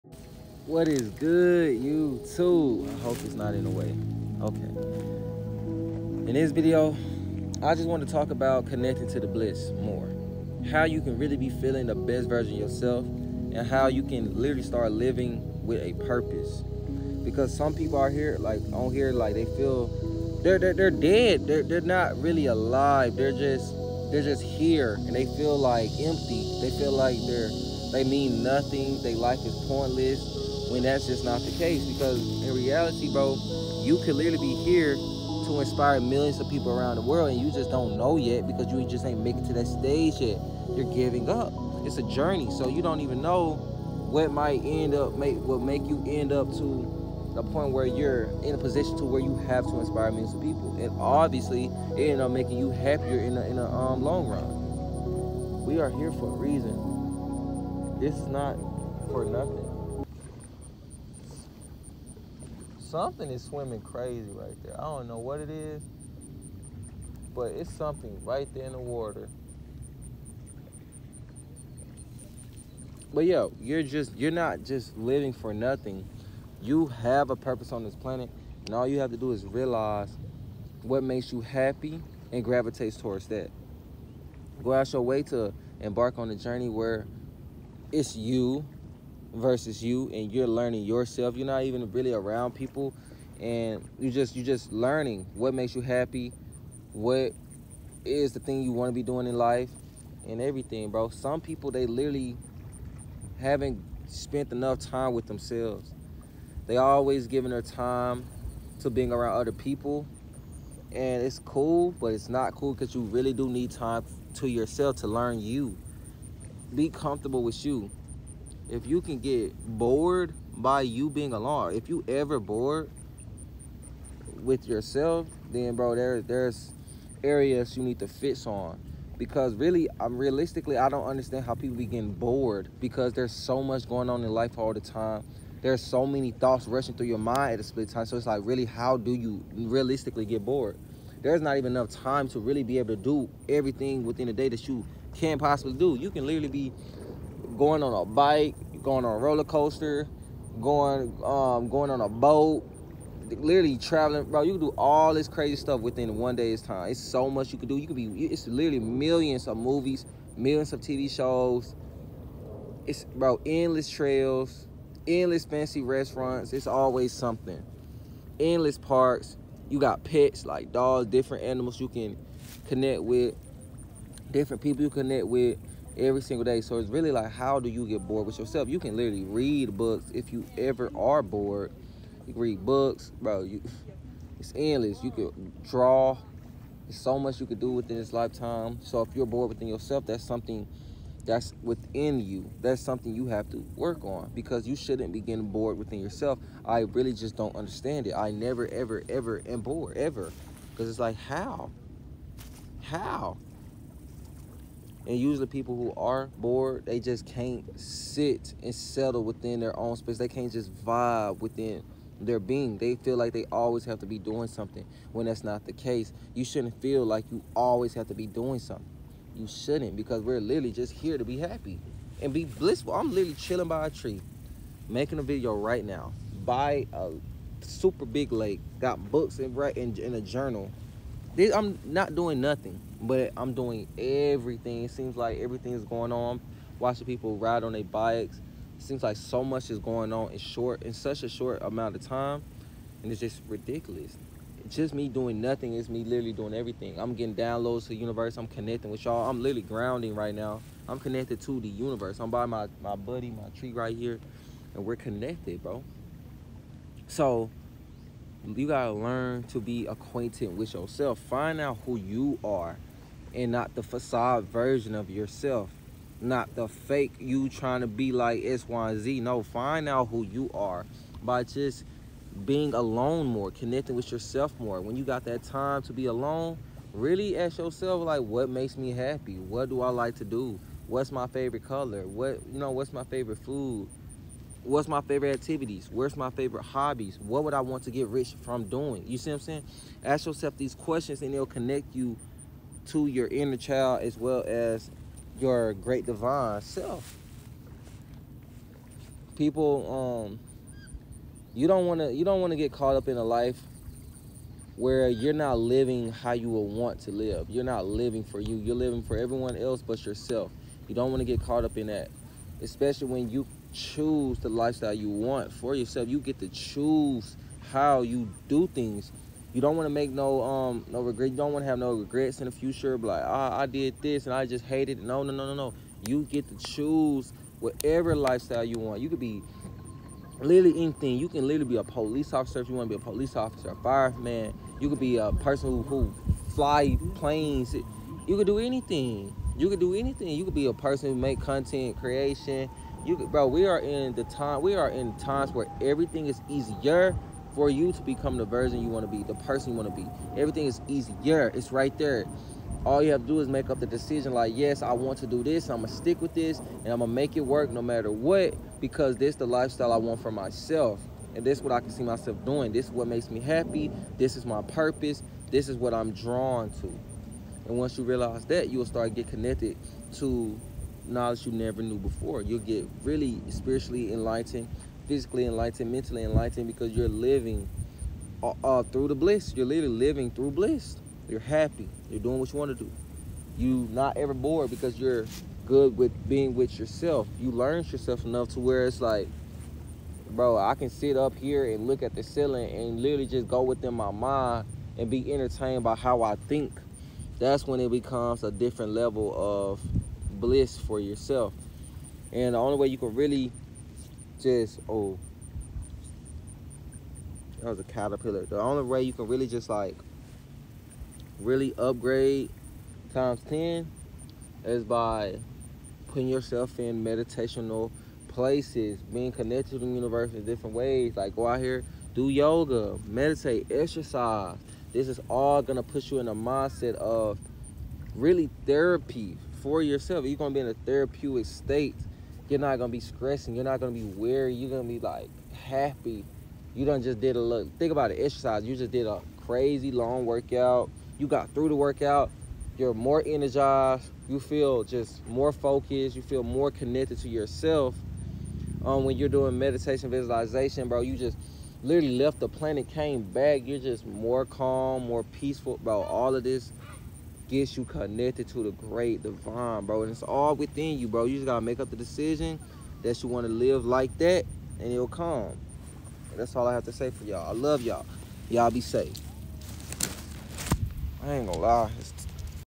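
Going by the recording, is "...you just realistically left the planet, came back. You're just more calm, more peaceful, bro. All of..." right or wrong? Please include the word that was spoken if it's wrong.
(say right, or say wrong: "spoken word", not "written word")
wrong: "literally", not "realistically".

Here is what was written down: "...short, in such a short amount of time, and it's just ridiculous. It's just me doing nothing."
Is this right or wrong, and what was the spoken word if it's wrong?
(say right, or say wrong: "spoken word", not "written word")
right.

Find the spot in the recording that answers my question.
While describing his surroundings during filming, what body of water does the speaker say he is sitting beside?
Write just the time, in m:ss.
3:47.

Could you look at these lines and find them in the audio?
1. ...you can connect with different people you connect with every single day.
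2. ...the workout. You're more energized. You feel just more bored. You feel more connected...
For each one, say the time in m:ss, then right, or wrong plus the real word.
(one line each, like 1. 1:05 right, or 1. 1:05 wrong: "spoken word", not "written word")
1. 2:51 right
2. 7:21 wrong: "focused", not "bored".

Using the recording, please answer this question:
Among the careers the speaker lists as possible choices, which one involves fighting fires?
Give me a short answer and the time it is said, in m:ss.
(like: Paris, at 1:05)
fireman, at 5:33.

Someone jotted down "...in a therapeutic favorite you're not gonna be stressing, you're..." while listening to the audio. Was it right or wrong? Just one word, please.
wrong.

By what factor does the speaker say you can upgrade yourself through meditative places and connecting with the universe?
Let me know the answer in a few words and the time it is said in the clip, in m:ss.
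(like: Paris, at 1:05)
10, at 6:53.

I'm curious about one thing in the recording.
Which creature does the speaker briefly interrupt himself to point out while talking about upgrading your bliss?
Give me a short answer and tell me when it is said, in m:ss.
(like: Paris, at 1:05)
a caterpillar, at 6:47.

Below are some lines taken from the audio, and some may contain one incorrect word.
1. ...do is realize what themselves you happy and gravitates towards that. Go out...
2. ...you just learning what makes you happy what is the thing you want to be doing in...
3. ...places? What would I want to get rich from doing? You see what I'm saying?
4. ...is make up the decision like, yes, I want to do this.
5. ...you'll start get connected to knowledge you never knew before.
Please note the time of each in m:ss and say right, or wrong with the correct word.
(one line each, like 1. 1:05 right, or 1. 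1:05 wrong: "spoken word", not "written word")
1. 1:19 wrong: "makes", not "themselves"
2. 1:34 right
3. 4:46 wrong: "hobbies", not "places"
4. 5:53 right
5. 6:08 right.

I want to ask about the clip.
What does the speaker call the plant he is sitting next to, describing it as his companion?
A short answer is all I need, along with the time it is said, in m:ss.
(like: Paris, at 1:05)
my buddy, my tree, at 4:12.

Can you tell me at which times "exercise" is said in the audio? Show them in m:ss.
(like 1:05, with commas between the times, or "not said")
7:03, 7:18.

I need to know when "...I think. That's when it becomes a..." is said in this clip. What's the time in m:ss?
6:36.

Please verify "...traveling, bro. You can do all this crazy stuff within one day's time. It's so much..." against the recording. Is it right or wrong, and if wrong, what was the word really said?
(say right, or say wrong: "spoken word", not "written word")
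right.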